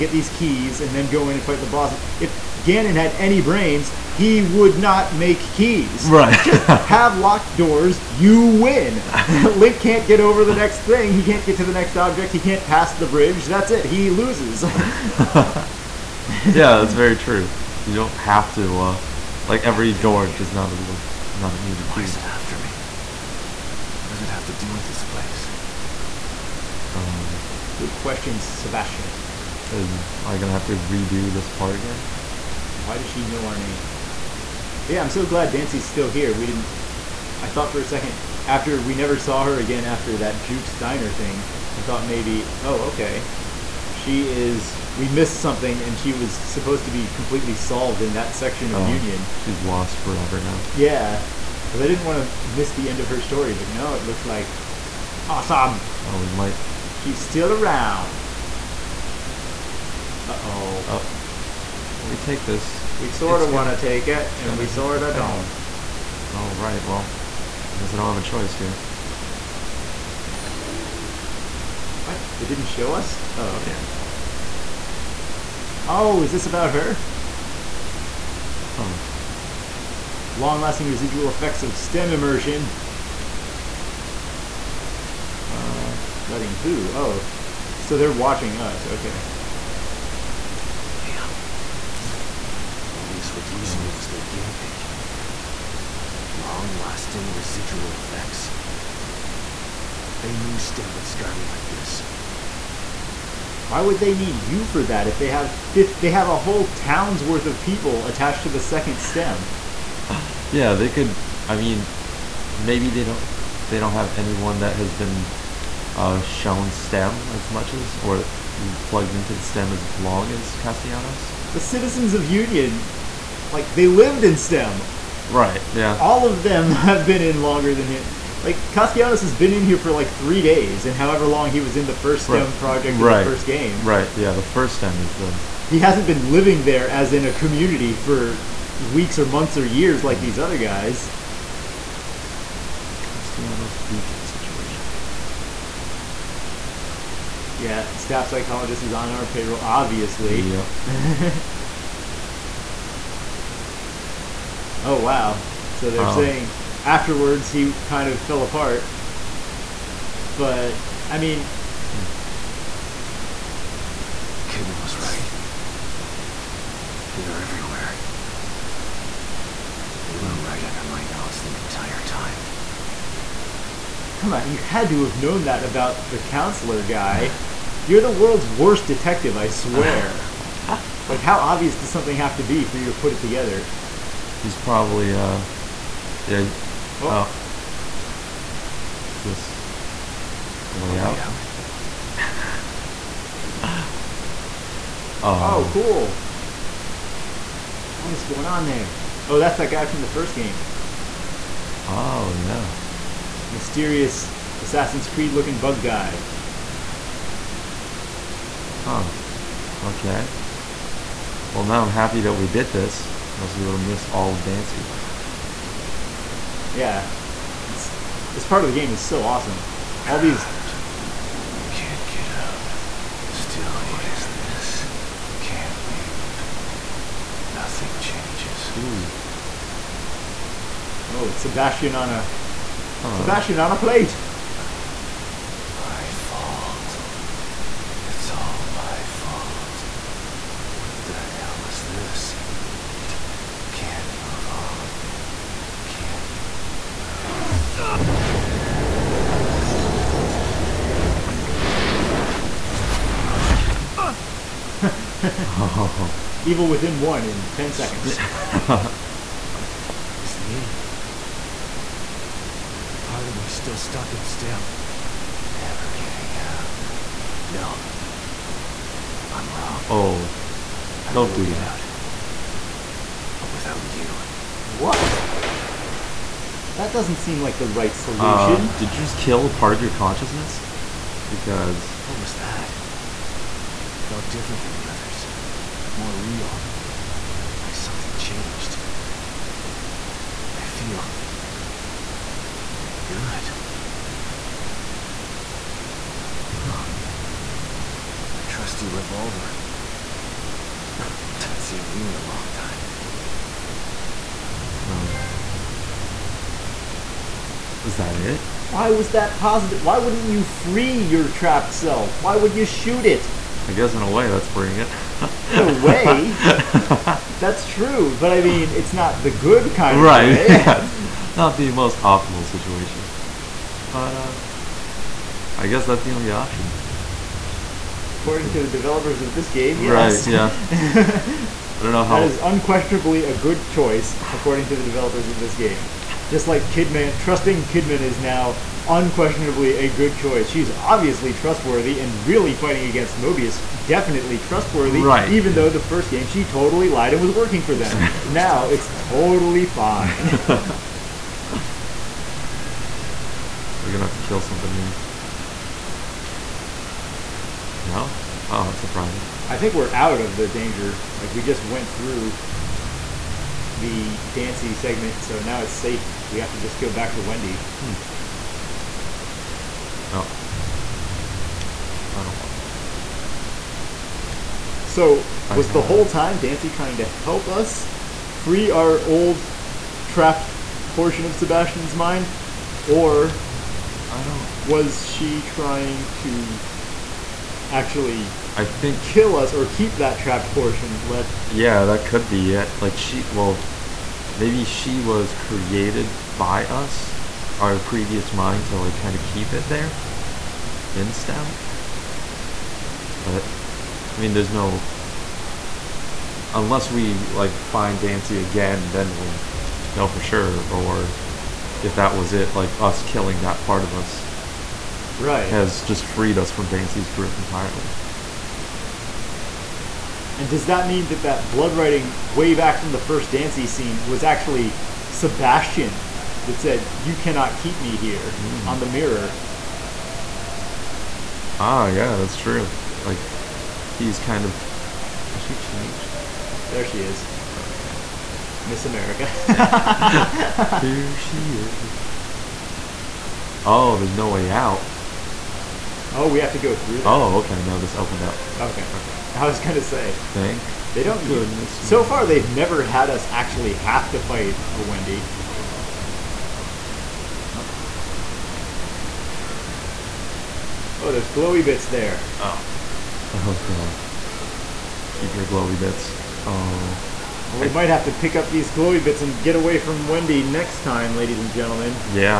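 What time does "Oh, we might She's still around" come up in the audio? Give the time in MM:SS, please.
00:56.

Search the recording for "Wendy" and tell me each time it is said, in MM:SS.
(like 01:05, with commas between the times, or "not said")
06:07, 07:34, 07:50.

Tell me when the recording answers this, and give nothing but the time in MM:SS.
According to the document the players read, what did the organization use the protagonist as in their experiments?
01:34.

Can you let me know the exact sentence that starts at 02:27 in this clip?
Yeah, staff psychologist is on our payroll, obviously.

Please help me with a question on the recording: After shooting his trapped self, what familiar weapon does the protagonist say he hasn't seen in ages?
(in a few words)
revolver.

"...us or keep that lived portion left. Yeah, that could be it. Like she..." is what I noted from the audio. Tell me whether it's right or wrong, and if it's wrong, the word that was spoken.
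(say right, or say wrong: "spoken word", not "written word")
wrong: "trapped", not "lived".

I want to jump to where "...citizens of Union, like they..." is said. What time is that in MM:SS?
02:01.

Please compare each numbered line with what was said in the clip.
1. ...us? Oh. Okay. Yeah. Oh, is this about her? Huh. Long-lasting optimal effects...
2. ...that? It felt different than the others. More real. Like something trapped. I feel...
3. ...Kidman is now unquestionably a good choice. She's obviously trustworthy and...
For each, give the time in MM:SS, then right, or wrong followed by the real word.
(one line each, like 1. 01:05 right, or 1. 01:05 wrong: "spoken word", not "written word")
1. 01:12 wrong: "residual", not "optimal"
2. 04:42 wrong: "changed", not "trapped"
3. 05:37 right.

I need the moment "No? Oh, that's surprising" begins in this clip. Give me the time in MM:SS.
05:57.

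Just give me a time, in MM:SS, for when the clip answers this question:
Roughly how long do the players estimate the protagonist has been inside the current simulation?
02:10.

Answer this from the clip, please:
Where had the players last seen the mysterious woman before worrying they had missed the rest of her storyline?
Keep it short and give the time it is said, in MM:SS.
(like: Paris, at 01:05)
Jukes Diner, at 00:40.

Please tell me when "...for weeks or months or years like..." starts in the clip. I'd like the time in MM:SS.
02:17.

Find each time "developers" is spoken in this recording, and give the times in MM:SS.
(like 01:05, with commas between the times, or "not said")
05:28, 05:34.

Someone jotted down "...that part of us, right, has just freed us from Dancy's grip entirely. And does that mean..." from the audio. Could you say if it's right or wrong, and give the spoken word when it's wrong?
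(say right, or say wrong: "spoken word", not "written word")
right.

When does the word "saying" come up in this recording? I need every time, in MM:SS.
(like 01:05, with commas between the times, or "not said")
02:36.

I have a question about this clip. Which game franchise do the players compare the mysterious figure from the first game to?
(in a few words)
Assassin's Creed.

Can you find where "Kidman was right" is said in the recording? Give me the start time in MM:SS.
02:44.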